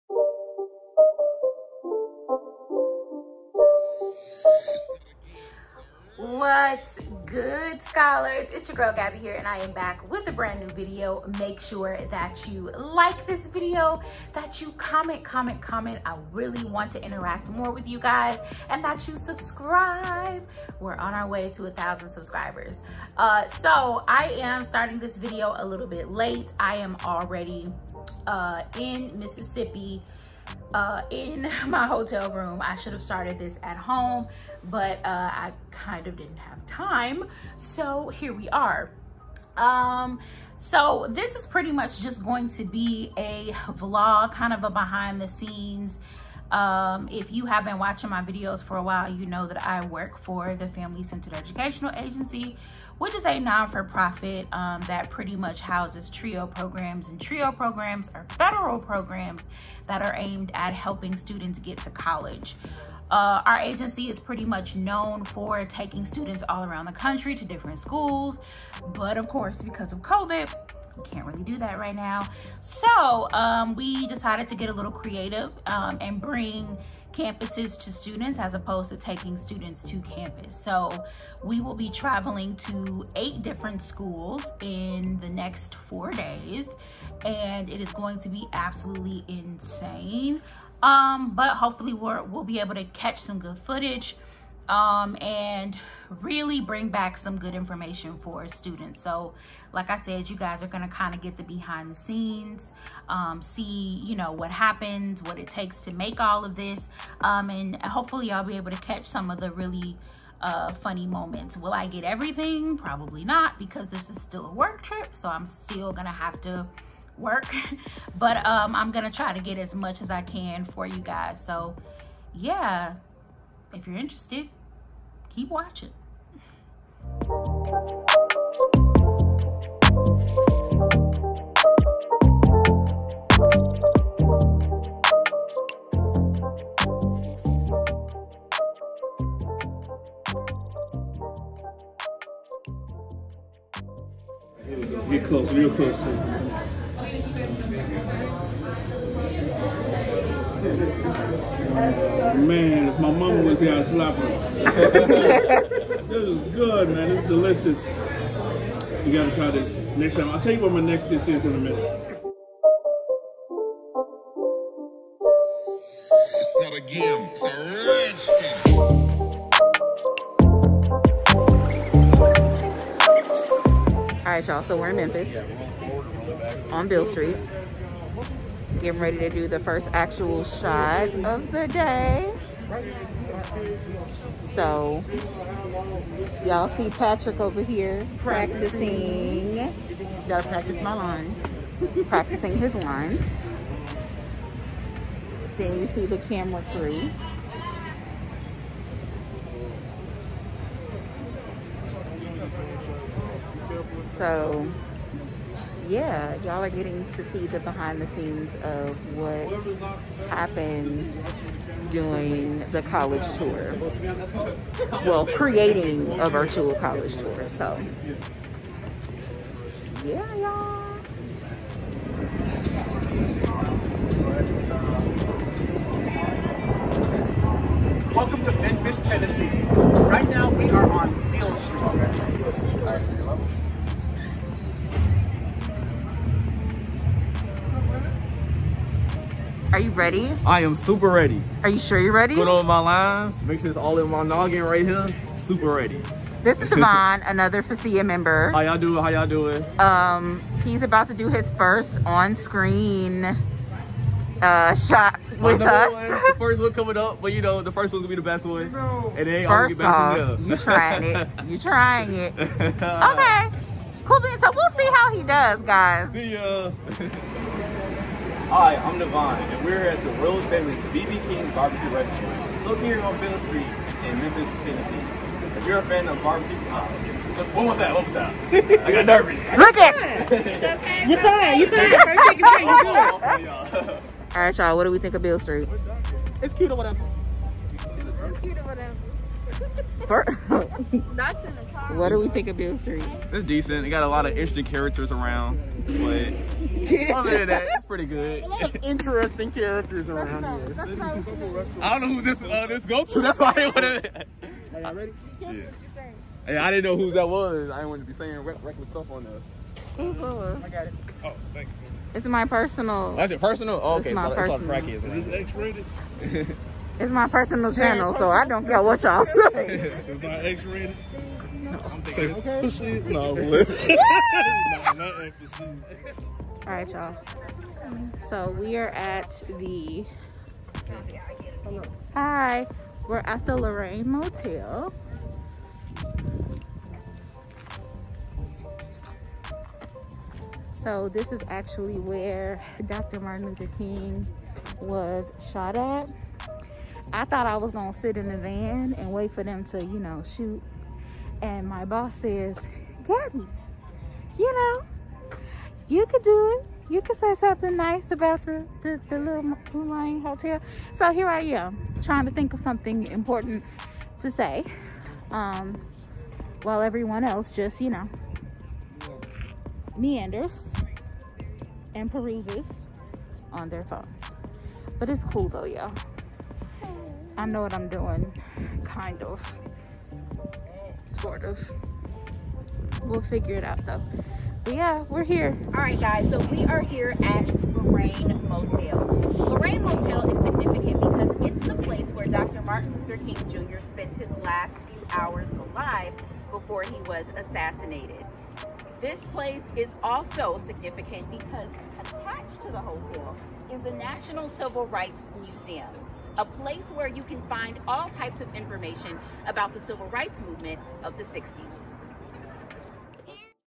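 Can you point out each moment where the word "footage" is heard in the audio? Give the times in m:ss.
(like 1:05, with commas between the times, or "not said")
1:33.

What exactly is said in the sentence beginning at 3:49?
Right now we are on Beale Street.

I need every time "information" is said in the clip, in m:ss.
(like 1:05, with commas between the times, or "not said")
1:37, 6:48.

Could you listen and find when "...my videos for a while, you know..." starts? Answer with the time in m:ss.
0:48.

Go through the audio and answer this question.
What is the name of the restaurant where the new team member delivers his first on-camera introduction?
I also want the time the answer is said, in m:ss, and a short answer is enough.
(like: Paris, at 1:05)
BB King's Barbecue Restaurant, at 4:30.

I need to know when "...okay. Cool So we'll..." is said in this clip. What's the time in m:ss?
4:22.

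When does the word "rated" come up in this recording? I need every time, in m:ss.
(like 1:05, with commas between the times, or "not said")
5:15, 5:20.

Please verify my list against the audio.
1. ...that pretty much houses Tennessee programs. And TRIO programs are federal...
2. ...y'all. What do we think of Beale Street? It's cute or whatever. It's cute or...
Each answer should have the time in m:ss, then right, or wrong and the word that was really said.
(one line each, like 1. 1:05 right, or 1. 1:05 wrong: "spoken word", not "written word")
1. 0:54 wrong: "TRIO", not "Tennessee"
2. 4:44 right.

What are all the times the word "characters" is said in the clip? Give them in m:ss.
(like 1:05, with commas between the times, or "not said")
4:54, 4:59.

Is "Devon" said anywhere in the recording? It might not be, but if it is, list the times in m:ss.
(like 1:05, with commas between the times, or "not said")
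4:06, 4:28.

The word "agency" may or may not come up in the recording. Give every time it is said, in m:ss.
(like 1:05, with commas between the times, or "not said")
0:51, 1:03.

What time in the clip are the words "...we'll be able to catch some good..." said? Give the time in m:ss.
1:32.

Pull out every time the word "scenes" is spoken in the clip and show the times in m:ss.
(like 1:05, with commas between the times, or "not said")
0:45, 1:41, 3:28.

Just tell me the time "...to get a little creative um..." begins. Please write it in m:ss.
1:14.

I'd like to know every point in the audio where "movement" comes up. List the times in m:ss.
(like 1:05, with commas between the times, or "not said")
6:50.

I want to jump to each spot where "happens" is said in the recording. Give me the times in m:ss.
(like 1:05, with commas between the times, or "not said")
1:44, 3:30.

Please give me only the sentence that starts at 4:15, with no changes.
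One, the first one coming up, but you know the first one's gonna be the best one.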